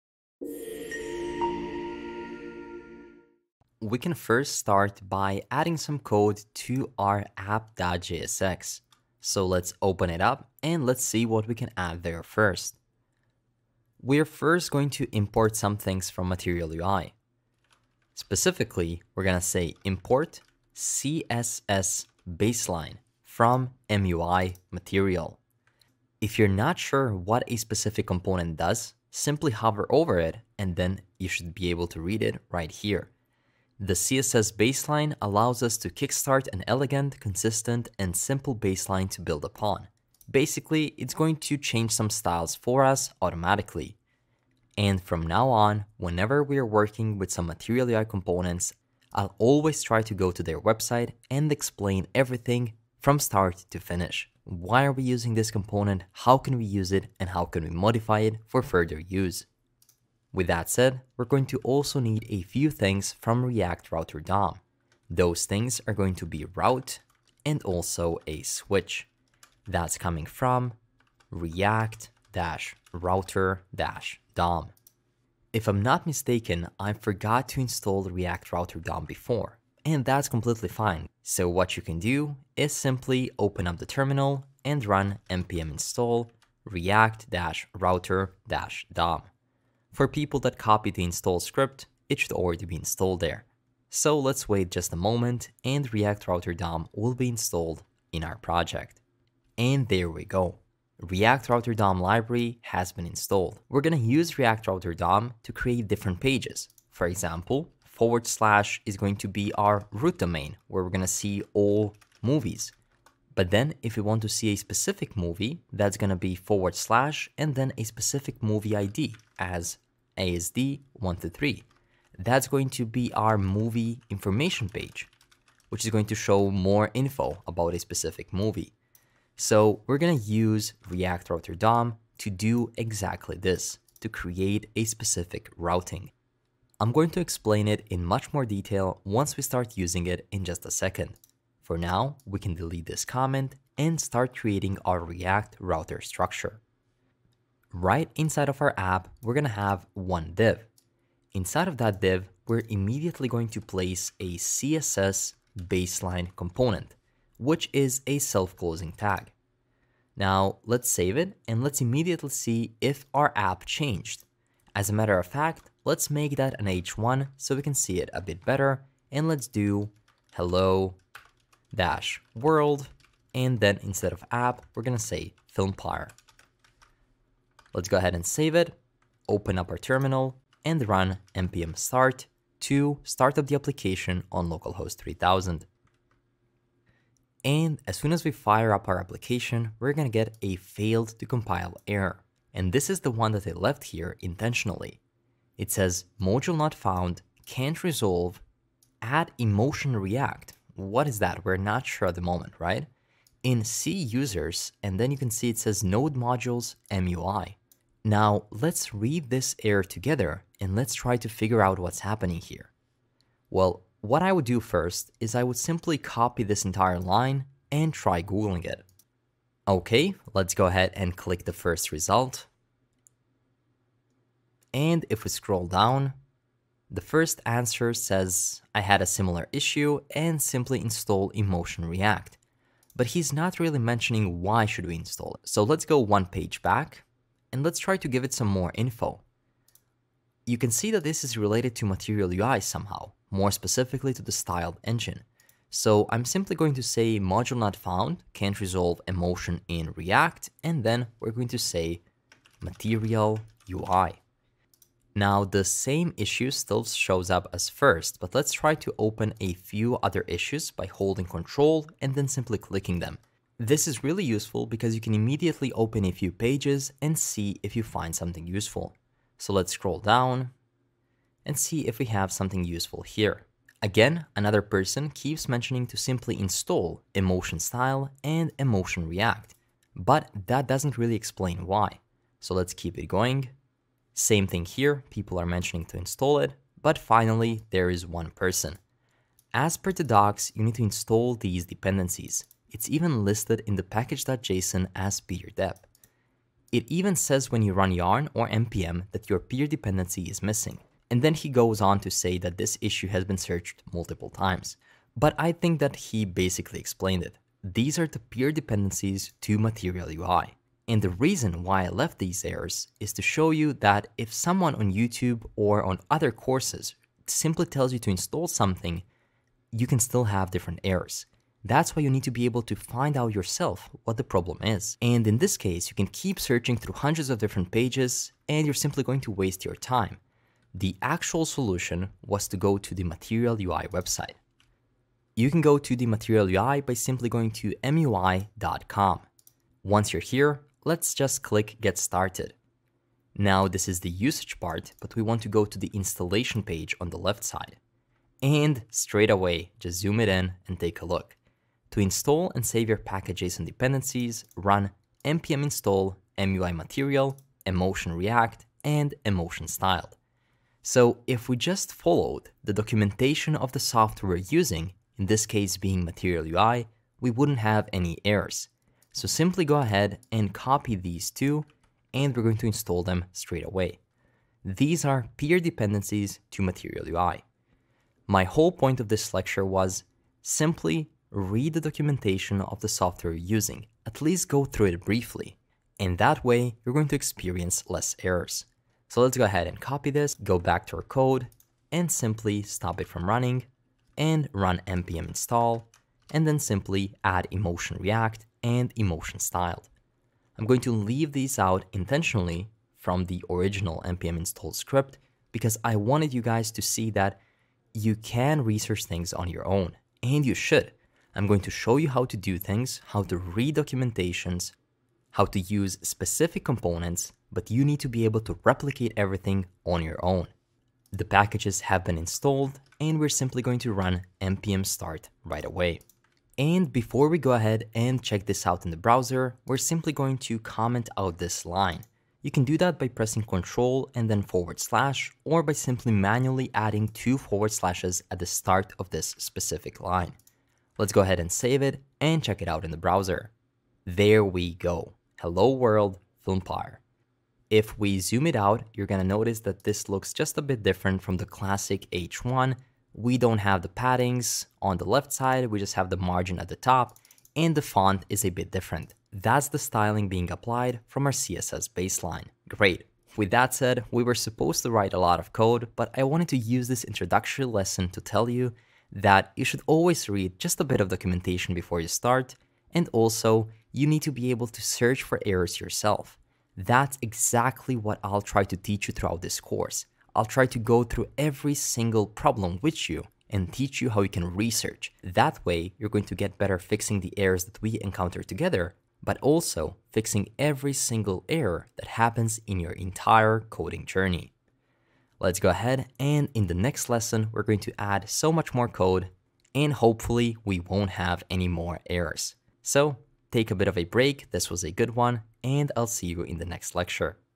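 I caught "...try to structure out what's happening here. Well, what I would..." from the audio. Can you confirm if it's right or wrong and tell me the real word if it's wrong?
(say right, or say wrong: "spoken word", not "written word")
wrong: "figure", not "structure".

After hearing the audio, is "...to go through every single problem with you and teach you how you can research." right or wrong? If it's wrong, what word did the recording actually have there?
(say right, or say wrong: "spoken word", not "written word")
right.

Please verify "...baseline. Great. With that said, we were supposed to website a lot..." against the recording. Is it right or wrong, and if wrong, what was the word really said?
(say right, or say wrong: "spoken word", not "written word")
wrong: "write", not "website".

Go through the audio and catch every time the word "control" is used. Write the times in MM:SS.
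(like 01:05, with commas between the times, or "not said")
04:21, 07:13.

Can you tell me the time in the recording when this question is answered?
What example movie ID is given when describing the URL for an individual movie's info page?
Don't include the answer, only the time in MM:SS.
02:00.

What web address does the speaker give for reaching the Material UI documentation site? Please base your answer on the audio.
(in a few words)
MUI.com.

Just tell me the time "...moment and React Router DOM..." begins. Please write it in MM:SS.
01:34.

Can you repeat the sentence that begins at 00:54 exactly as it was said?
Why are we using this component?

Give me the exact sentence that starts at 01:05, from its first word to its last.
Those things are going to be route and also a switch.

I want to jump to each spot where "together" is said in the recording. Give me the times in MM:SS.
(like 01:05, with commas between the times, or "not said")
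03:29, 08:08.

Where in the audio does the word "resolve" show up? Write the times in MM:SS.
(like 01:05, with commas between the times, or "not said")
03:17, 04:08.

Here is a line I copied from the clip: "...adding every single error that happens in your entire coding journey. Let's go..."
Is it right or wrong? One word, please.
wrong.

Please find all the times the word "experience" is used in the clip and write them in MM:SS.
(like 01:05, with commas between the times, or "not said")
06:27.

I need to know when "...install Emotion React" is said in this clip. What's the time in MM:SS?
03:50.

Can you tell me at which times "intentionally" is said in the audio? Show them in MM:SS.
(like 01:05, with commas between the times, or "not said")
03:14, 06:41.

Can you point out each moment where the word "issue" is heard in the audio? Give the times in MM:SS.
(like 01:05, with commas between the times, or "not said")
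03:49, 04:16, 04:20, 05:02.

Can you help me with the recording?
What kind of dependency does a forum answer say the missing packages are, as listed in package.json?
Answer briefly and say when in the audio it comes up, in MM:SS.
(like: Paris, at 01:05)
peer dependency, at 04:55.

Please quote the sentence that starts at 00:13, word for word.
We're first going to import some things from Material UI.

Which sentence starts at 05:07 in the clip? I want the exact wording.
These are the peer dependencies to Material UI.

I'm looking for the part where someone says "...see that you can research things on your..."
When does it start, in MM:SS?
06:46.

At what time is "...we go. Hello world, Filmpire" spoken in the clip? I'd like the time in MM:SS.
07:24.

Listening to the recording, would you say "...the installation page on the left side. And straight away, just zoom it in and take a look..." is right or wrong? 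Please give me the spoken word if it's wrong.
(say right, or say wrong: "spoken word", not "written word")
right.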